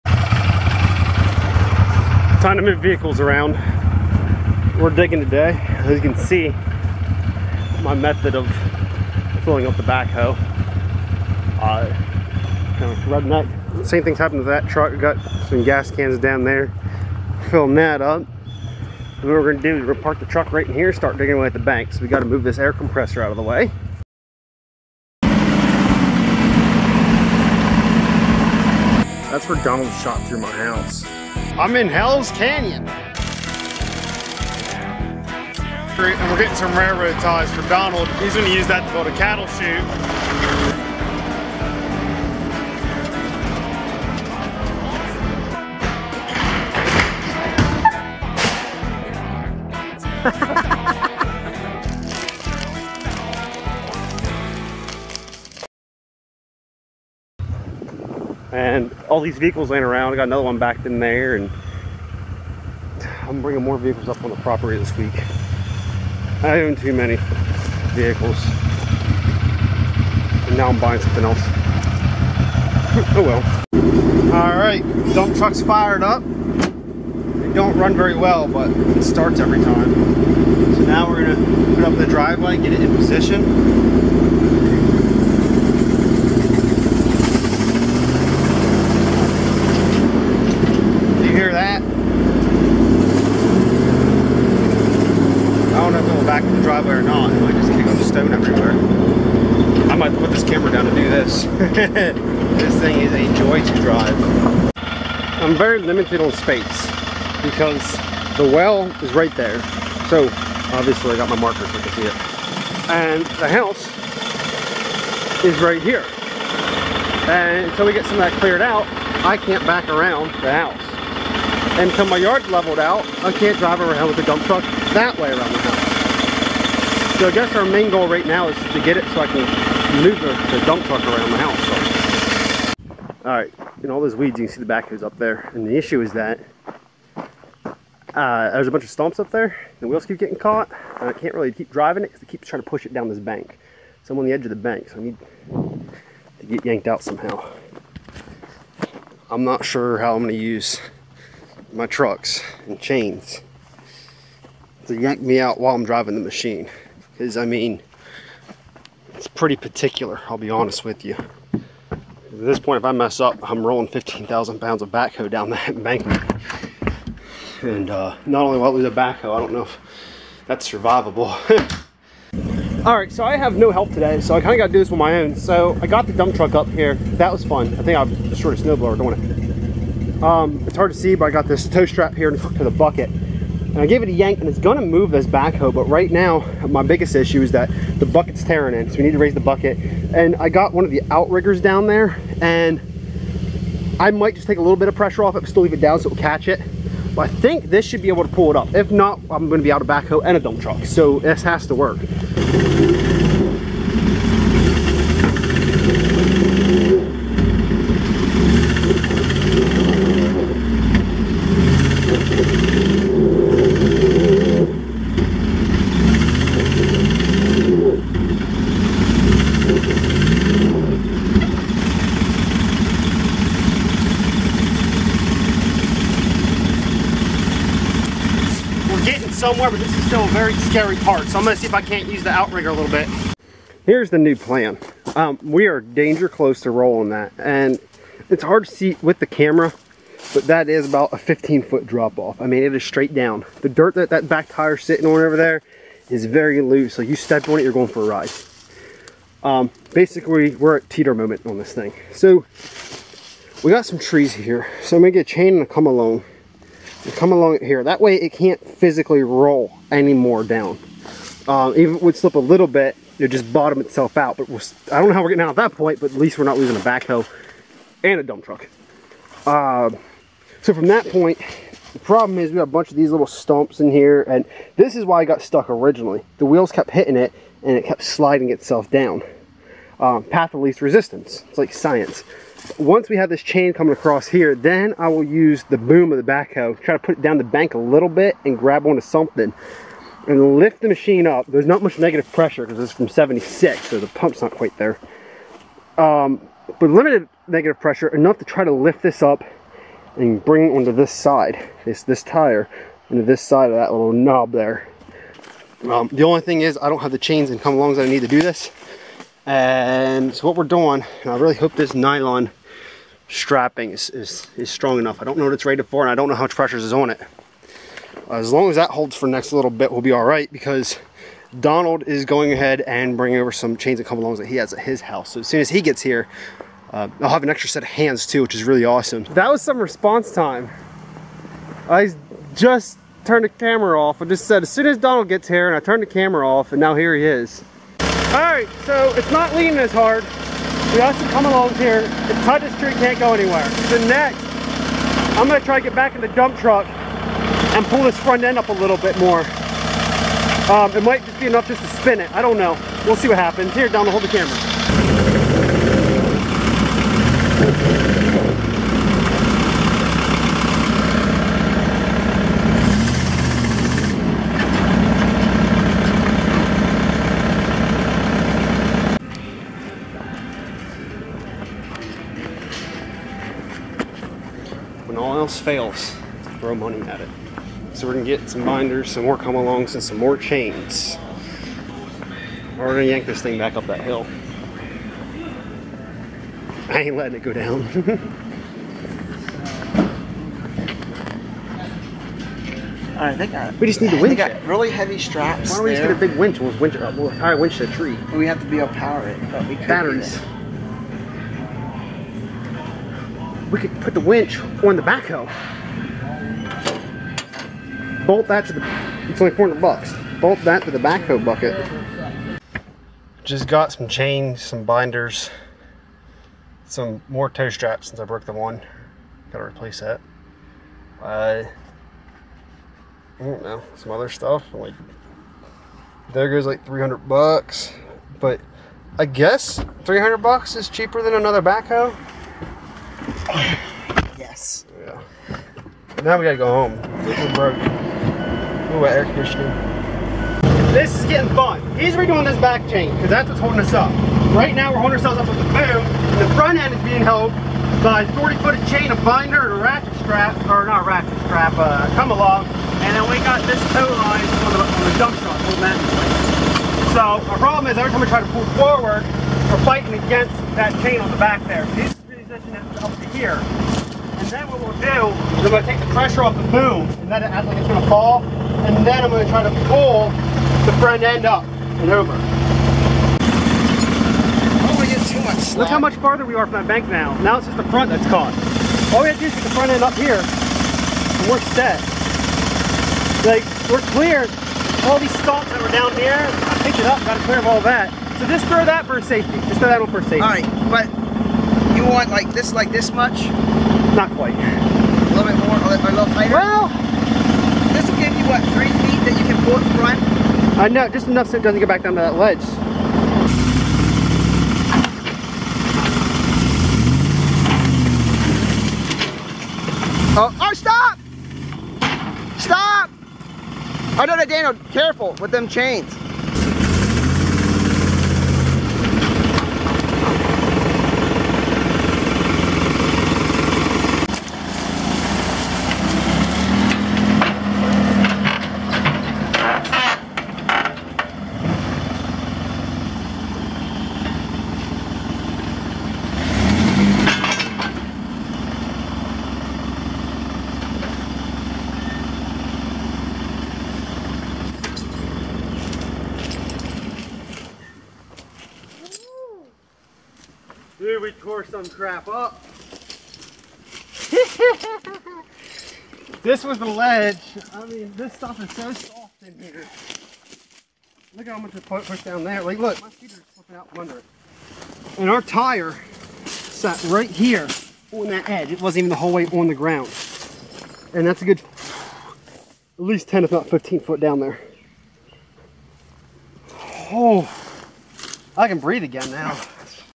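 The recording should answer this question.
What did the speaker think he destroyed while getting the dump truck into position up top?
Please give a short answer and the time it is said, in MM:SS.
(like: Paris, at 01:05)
A snowblower, at 02:58.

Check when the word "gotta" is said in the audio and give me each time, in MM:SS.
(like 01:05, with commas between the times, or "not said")
00:22, 06:59, 07:16.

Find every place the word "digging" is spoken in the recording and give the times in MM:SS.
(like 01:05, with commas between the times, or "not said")
00:04, 00:21.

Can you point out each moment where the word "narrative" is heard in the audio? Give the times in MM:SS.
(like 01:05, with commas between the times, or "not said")
not said.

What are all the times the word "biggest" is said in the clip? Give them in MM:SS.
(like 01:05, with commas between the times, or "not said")
03:06.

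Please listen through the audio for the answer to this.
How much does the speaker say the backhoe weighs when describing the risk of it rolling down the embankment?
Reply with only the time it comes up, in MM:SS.
02:43.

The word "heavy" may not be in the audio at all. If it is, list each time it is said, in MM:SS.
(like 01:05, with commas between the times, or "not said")
06:34.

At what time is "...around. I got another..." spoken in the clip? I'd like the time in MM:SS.
00:59.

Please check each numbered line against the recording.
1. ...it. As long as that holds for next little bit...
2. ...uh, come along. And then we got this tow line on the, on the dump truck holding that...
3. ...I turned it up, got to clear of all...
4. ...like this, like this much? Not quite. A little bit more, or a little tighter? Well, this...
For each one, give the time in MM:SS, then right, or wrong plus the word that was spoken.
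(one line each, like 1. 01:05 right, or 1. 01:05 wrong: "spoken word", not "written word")
1. 05:17 right
2. 07:31 right
3. 08:06 wrong: "picked", not "turned"
4. 08:12 right.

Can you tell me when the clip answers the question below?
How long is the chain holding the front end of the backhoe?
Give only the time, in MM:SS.
07:28.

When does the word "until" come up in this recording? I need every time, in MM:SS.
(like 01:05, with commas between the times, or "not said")
01:57, 02:01.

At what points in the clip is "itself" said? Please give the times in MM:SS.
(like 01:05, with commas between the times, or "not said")
04:23, 04:38.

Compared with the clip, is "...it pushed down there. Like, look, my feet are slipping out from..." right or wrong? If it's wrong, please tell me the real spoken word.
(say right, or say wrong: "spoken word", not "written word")
right.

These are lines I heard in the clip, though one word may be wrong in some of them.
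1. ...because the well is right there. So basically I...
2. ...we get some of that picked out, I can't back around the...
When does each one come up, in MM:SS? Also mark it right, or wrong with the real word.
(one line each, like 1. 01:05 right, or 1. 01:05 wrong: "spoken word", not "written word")
1. 01:47 wrong: "obviously", not "basically"
2. 01:57 wrong: "cleared", not "picked".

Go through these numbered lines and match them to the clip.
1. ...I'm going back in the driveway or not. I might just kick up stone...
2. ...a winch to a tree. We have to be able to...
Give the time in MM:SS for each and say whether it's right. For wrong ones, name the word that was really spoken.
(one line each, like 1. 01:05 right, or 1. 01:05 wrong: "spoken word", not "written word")
1. 01:36 right
2. 06:37 right.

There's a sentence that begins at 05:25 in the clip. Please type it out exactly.
So as soon as he gets here, uh, I'll have an extra set of hands too, which is really awesome.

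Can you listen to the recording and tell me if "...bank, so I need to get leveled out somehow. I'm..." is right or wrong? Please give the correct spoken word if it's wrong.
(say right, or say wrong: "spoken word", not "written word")
wrong: "yanked", not "leveled".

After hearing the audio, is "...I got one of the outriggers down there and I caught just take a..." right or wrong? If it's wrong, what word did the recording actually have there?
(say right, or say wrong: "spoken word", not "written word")
wrong: "might", not "caught".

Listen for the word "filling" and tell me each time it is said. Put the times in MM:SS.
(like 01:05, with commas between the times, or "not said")
00:09, 00:17.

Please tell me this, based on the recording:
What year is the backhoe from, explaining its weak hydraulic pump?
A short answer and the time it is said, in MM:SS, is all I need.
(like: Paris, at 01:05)
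1976, at 04:53.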